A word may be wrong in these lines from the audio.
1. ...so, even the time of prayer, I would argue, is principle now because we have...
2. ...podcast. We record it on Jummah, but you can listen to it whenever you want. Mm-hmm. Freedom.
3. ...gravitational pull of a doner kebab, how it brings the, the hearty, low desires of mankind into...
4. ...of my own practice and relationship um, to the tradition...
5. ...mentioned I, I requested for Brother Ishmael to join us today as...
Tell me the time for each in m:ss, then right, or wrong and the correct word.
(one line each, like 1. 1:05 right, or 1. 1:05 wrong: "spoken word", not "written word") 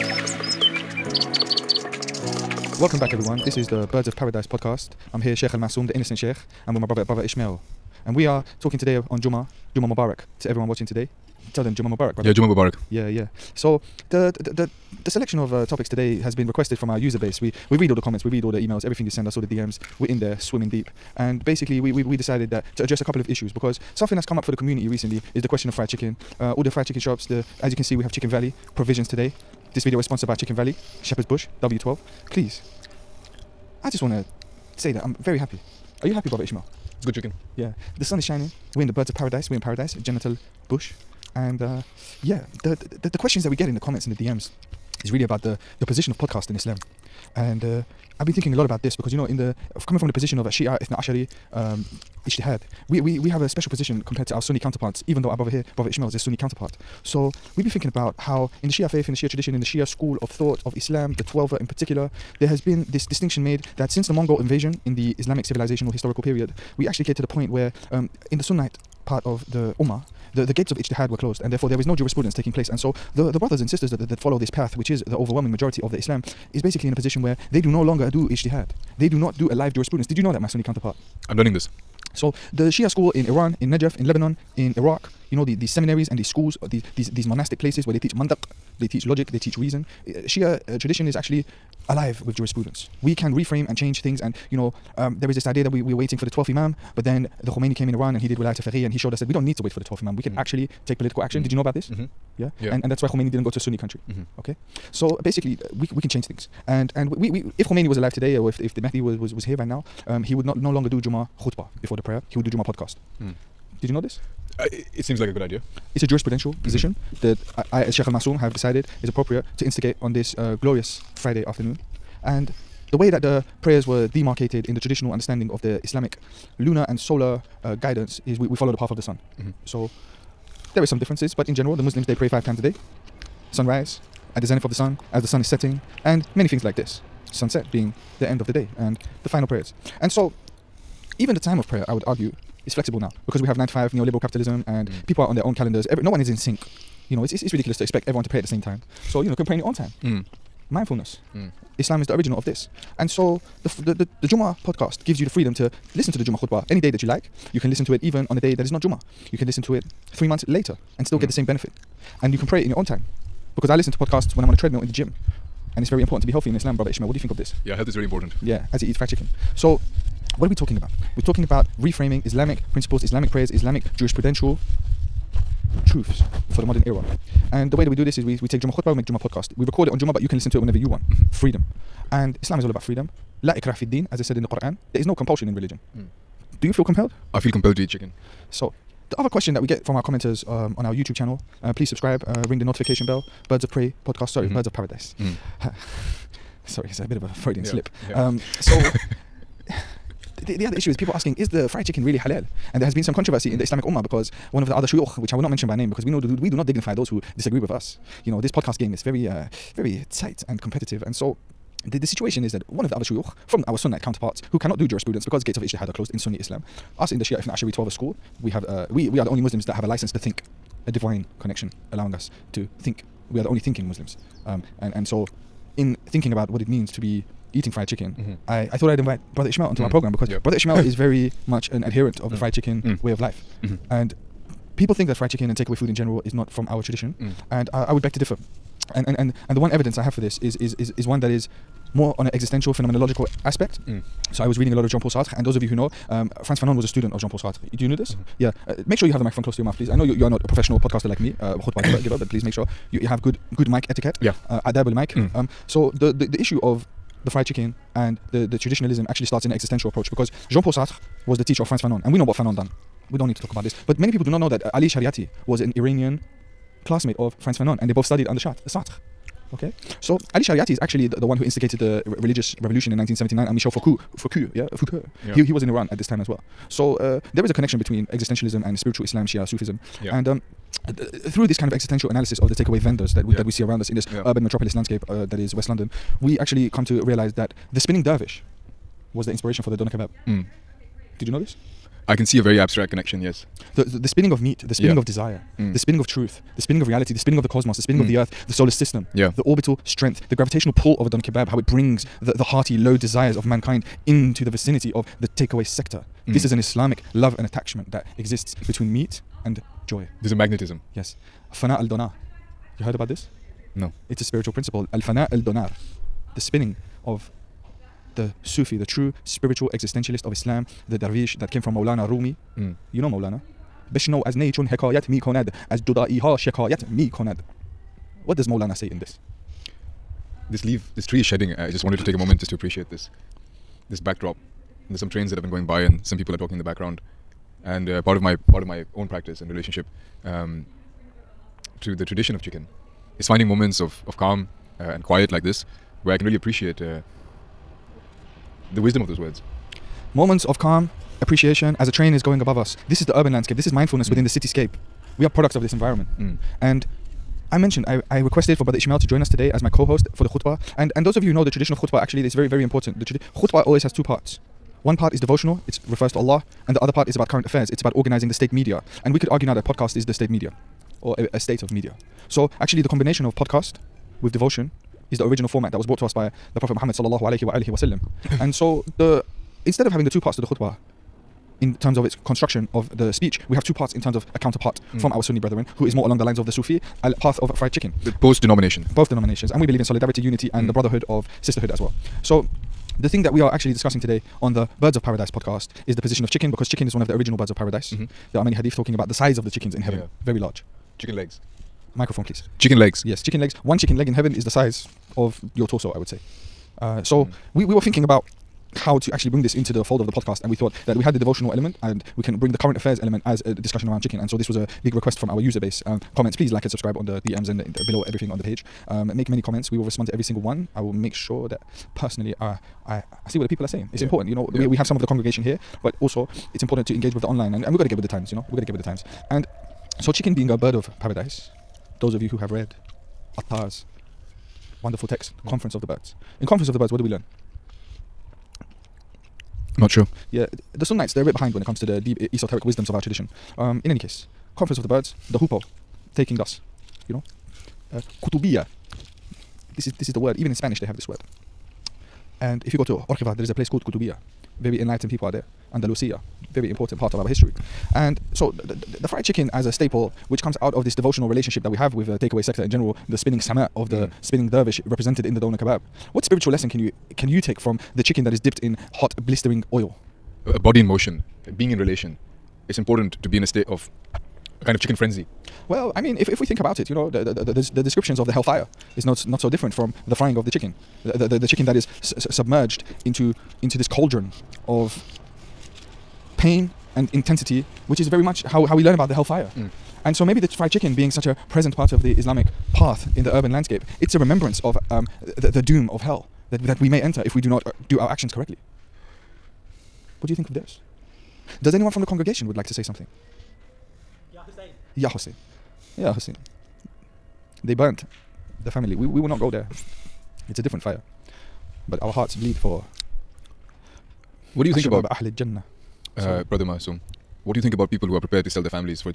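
1. 2:20 wrong: "flexible", not "principle"
2. 2:59 right
3. 5:00 right
4. 5:38 right
5. 5:57 right.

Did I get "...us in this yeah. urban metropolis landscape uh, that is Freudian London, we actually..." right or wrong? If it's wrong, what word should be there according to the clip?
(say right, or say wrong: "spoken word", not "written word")
wrong: "West", not "Freudian".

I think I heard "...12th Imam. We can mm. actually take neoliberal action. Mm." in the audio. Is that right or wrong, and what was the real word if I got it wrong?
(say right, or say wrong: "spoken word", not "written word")
wrong: "political", not "neoliberal".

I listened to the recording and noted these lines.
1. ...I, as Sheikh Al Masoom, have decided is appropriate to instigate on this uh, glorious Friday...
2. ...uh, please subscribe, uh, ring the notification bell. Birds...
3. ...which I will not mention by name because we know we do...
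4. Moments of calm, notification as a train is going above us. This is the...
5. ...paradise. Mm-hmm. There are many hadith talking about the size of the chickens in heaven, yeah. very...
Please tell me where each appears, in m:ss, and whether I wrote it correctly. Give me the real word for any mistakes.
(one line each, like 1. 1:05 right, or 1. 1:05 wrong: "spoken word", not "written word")
1. 1:57 right
2. 3:11 right
3. 3:25 right
4. 5:50 wrong: "appreciation", not "notification"
5. 6:37 right.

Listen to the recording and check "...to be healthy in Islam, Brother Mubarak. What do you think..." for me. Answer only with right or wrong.
wrong.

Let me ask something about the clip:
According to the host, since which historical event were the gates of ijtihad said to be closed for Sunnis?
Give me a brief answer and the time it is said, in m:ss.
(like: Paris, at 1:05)
The Mongol invasion, at 1:04.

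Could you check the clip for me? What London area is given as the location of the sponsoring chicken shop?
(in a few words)
Shepherd's Bush.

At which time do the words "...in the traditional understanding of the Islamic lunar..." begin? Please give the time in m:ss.
2:04.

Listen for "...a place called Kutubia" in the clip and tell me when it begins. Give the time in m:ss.
7:33.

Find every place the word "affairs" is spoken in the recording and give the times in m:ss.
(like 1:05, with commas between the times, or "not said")
6:07, 6:52.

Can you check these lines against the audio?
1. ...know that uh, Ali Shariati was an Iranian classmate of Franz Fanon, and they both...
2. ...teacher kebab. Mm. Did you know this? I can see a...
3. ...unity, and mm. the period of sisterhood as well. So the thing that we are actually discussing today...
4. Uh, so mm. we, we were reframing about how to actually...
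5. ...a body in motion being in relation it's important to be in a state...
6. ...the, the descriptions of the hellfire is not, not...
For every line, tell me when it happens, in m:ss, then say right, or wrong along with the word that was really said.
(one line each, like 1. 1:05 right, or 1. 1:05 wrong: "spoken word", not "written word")
1. 4:24 right
2. 4:49 wrong: "doner", not "teacher"
3. 6:30 wrong: "brotherhood", not "period"
4. 6:46 wrong: "thinking", not "reframing"
5. 7:50 right
6. 7:57 right.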